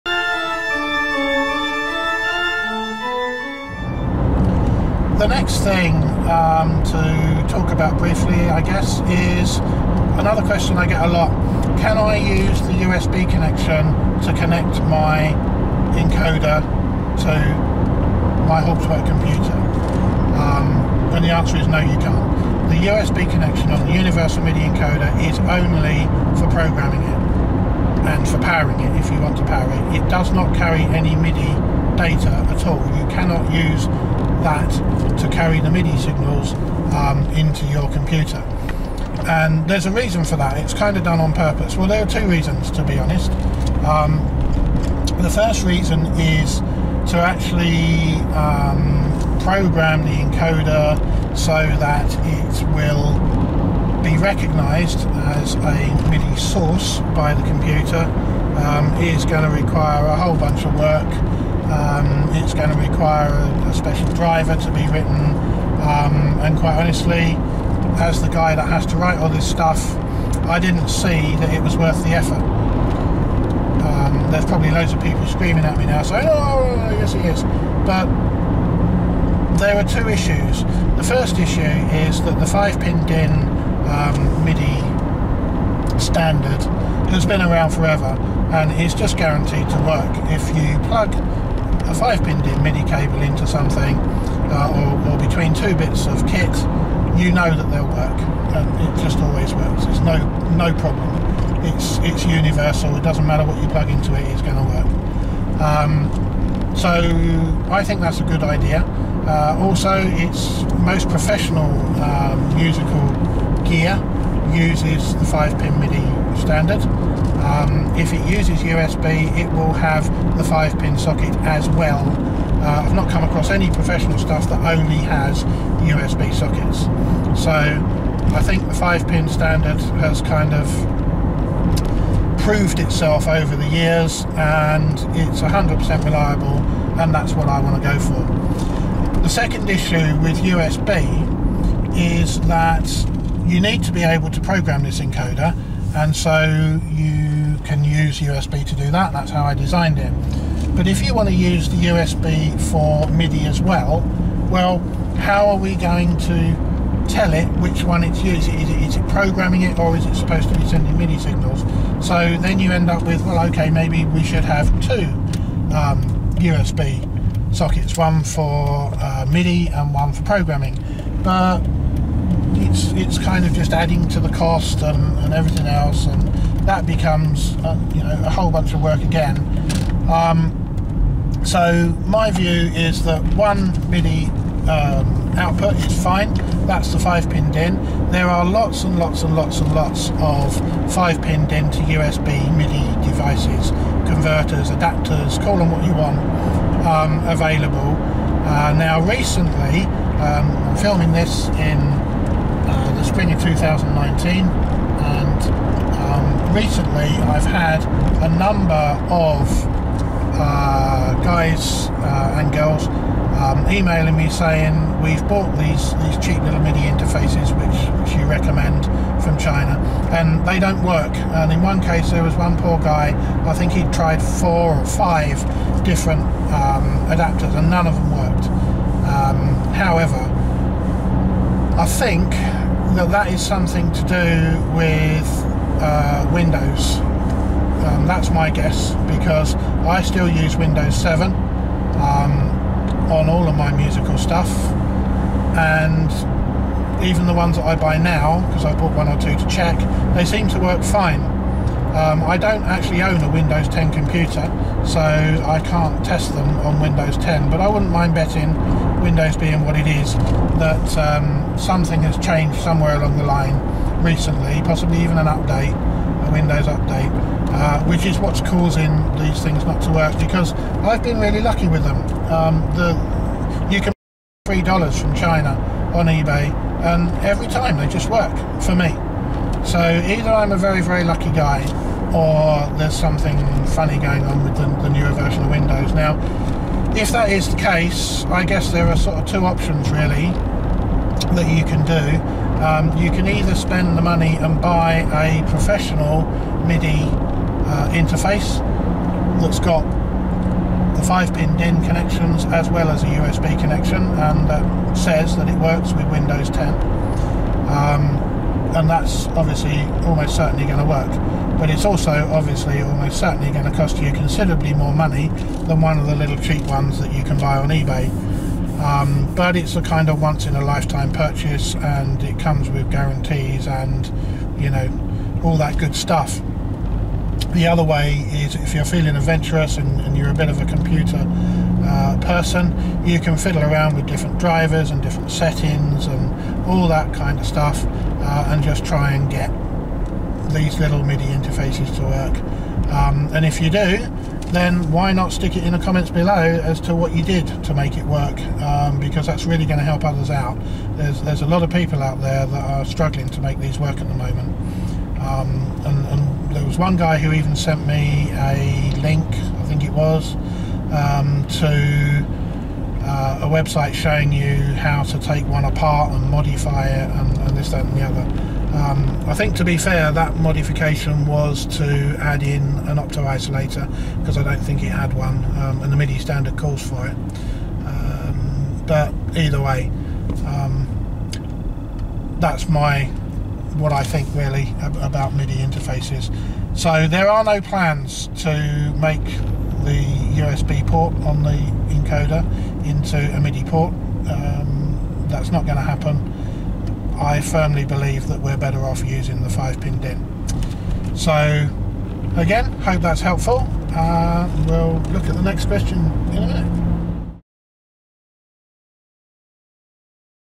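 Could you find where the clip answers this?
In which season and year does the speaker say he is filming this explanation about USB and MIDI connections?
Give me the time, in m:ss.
3:23.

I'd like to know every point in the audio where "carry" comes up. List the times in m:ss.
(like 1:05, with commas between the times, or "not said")
0:30, 0:35.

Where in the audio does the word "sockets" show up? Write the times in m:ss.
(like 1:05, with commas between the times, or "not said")
2:00, 2:06, 2:47.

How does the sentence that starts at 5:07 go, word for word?
Um, and that's obviously almost certainly going to work.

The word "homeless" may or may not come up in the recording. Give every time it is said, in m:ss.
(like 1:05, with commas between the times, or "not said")
not said.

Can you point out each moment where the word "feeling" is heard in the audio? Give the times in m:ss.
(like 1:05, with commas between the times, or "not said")
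5:28.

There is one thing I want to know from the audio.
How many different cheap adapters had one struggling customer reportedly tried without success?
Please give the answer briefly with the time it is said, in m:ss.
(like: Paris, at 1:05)
4 or 5, at 3:44.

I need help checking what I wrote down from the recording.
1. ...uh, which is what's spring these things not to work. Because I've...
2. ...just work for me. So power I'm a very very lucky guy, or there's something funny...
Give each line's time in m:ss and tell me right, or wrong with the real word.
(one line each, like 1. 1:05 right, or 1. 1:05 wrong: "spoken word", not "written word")
1. 4:27 wrong: "causing", not "spring"
2. 4:37 wrong: "either", not "power".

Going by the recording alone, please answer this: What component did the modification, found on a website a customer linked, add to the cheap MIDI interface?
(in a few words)
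An opto isolator.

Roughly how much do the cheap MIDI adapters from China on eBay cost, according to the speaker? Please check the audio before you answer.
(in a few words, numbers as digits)
$3.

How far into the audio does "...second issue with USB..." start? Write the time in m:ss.
2:19.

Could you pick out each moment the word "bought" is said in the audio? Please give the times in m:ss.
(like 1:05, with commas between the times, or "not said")
3:35, 4:08.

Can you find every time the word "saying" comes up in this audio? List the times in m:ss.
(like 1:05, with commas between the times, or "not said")
1:16, 3:34.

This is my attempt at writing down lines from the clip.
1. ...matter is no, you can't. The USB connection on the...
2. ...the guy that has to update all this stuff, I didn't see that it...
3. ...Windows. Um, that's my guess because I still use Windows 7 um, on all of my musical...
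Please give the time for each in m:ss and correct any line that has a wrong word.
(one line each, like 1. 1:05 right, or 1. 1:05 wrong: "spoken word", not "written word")
1. 0:21 wrong: "answer", not "matter"
2. 1:08 wrong: "write", not "update"
3. 3:56 right.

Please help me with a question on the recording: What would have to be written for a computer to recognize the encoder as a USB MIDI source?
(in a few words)
A special driver.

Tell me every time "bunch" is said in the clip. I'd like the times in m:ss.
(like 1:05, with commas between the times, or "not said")
1:00, 2:58.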